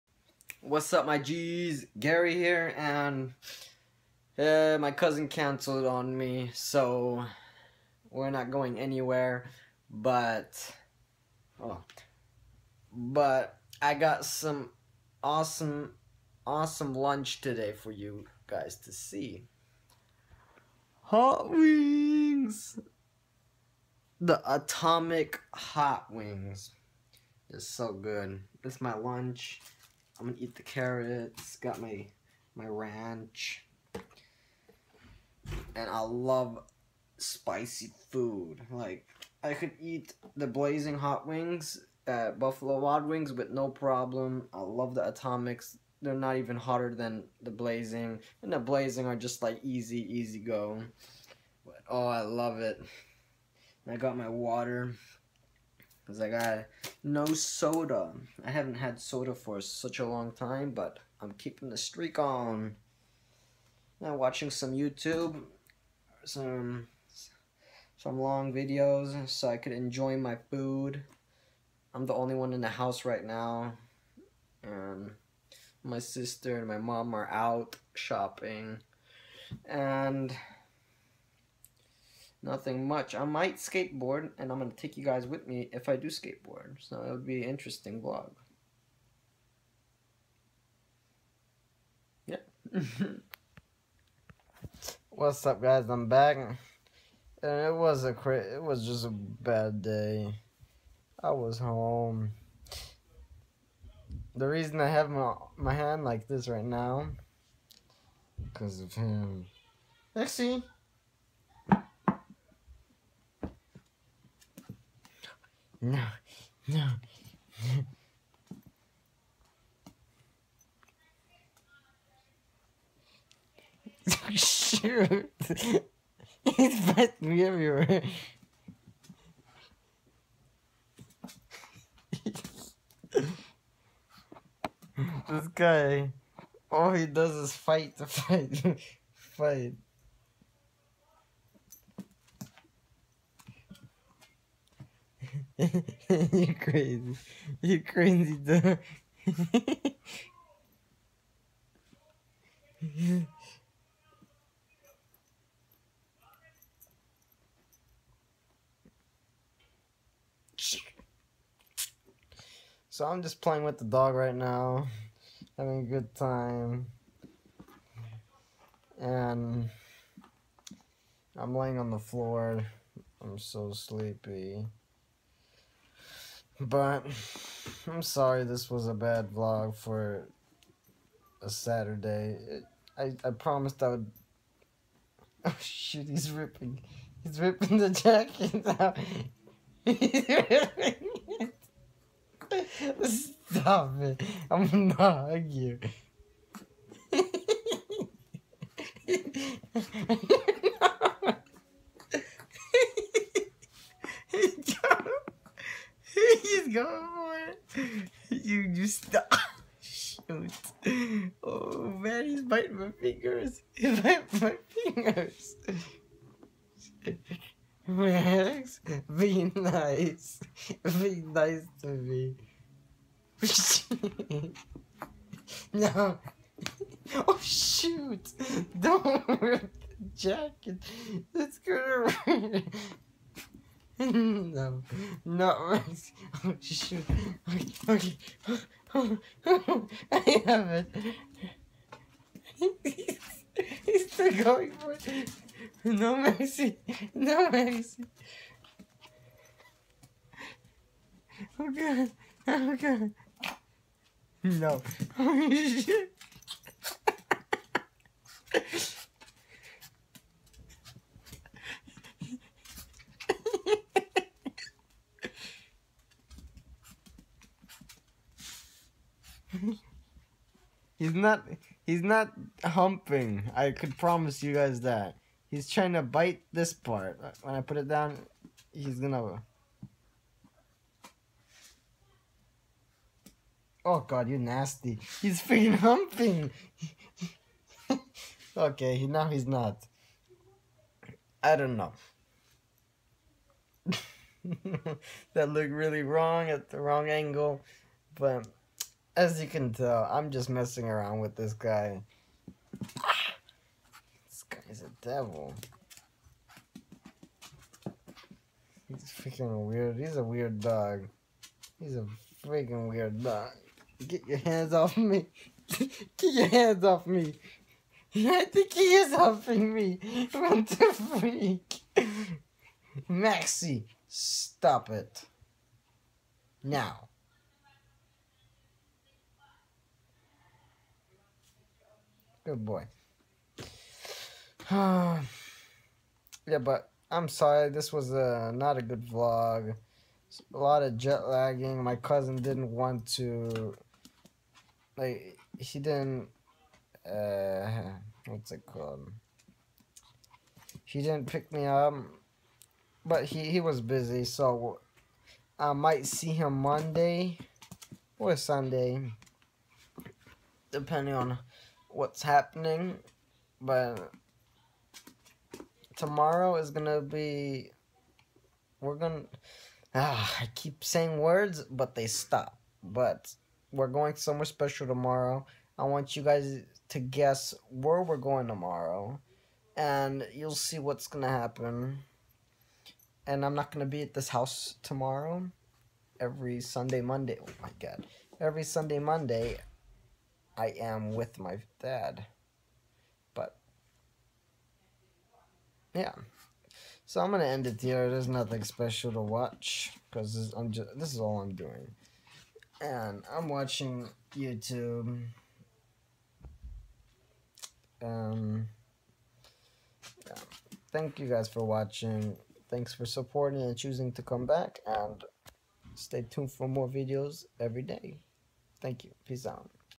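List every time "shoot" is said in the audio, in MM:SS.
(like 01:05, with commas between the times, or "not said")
02:04, 03:05, 03:30, 03:47, 03:56.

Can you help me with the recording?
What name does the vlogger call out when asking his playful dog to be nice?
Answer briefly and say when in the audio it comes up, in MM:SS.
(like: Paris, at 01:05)
Max, at 03:37.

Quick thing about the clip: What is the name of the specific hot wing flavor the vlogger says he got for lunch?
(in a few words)
Atomic.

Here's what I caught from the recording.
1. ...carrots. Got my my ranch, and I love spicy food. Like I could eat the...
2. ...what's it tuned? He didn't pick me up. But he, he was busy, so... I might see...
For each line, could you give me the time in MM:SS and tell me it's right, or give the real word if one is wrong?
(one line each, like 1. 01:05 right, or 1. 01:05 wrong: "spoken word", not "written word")
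1. 00:30 right
2. 05:48 wrong: "called", not "tuned".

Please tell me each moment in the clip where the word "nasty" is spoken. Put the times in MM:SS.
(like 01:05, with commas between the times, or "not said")
04:44.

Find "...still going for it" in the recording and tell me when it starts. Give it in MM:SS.
04:04.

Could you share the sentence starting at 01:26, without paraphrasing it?
So it would be an interesting vlog.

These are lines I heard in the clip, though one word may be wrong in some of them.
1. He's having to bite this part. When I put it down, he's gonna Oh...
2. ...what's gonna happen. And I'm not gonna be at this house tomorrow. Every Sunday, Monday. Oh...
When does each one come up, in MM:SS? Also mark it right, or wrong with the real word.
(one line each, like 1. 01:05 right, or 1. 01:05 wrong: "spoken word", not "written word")
1. 04:35 wrong: "trying", not "having"
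2. 06:20 right.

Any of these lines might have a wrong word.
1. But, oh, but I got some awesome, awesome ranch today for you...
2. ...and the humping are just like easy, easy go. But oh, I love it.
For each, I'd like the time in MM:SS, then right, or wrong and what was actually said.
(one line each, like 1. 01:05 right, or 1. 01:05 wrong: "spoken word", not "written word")
1. 00:09 wrong: "lunch", not "ranch"
2. 00:48 wrong: "blazing", not "humping".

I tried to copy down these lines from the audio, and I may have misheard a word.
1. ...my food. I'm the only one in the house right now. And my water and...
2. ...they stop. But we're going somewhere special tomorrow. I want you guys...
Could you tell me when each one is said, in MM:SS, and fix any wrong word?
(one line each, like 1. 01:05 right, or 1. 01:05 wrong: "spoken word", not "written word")
1. 01:10 wrong: "sister", not "water"
2. 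06:11 right.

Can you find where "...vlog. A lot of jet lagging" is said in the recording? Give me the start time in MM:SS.
05:39.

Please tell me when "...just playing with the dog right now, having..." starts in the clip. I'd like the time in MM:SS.
02:43.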